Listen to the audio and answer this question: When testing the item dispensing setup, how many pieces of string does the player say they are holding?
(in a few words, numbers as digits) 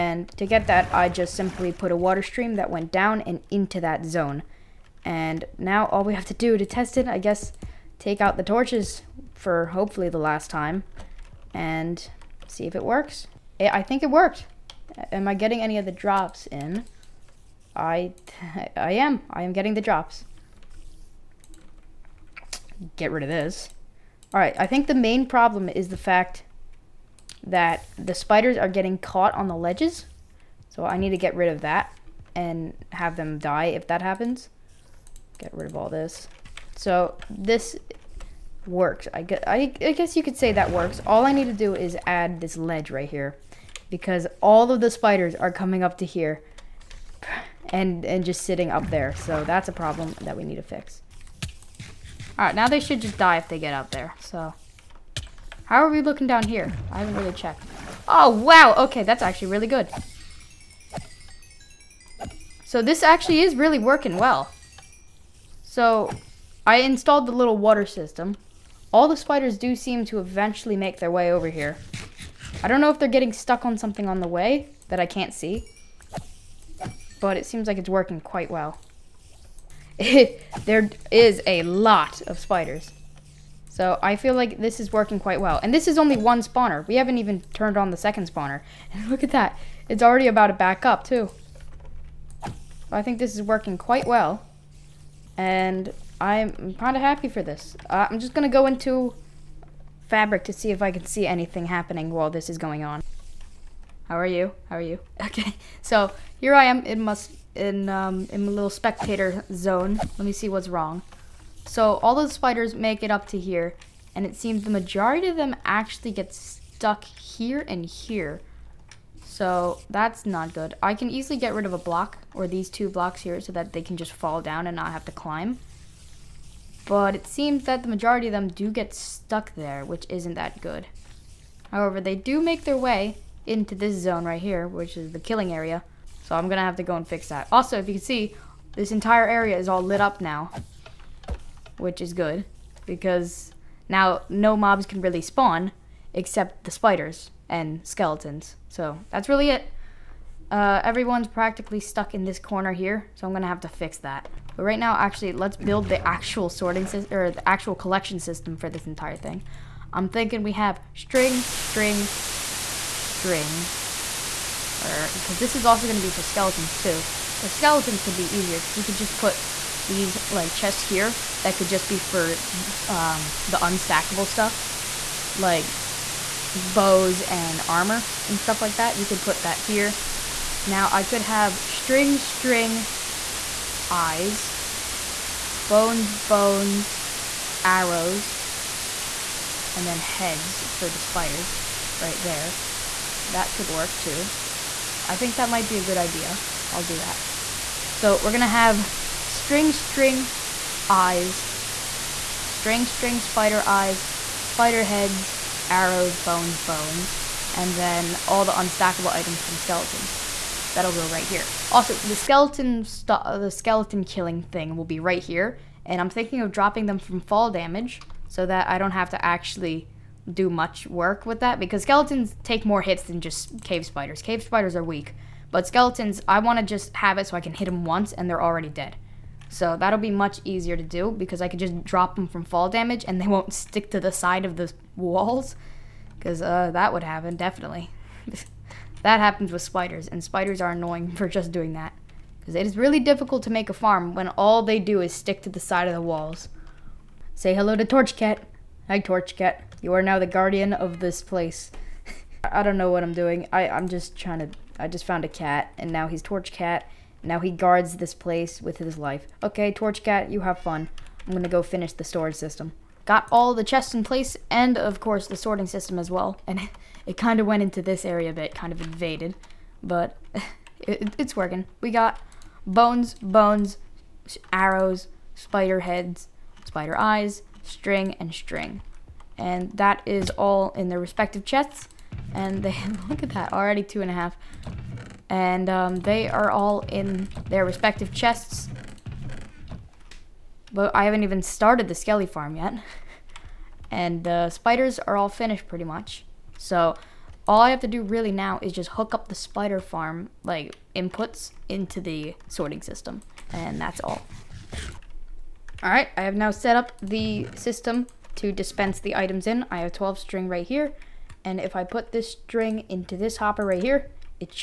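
12.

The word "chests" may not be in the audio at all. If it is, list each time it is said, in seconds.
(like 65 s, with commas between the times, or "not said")
170 s, 263 s, 281 s, 288 s.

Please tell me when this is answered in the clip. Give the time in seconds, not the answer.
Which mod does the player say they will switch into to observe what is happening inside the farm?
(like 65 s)
100 s.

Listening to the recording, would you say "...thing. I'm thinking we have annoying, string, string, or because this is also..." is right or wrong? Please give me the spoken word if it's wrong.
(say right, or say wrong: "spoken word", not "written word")
wrong: "string", not "annoying".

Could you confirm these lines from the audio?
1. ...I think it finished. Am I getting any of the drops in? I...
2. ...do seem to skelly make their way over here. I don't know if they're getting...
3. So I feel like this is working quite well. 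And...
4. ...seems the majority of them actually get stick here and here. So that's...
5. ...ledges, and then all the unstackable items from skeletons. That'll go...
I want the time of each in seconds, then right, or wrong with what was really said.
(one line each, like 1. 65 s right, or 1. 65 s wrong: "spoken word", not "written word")
1. 13 s wrong: "worked", not "finished"
2. 69 s wrong: "eventually", not "skelly"
3. 83 s right
4. 114 s wrong: "stuck", not "stick"
5. 206 s wrong: "bones", not "ledges".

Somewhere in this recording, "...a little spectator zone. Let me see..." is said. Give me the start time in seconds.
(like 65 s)
108 s.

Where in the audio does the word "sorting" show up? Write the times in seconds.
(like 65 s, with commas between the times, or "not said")
156 s, 265 s, 302 s.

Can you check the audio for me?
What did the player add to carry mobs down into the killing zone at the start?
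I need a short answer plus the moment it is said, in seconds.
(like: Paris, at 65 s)
a water stream, at 1 s.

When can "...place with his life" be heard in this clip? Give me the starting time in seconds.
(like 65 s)
258 s.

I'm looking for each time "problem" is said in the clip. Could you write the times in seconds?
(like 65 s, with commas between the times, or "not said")
25 s, 49 s.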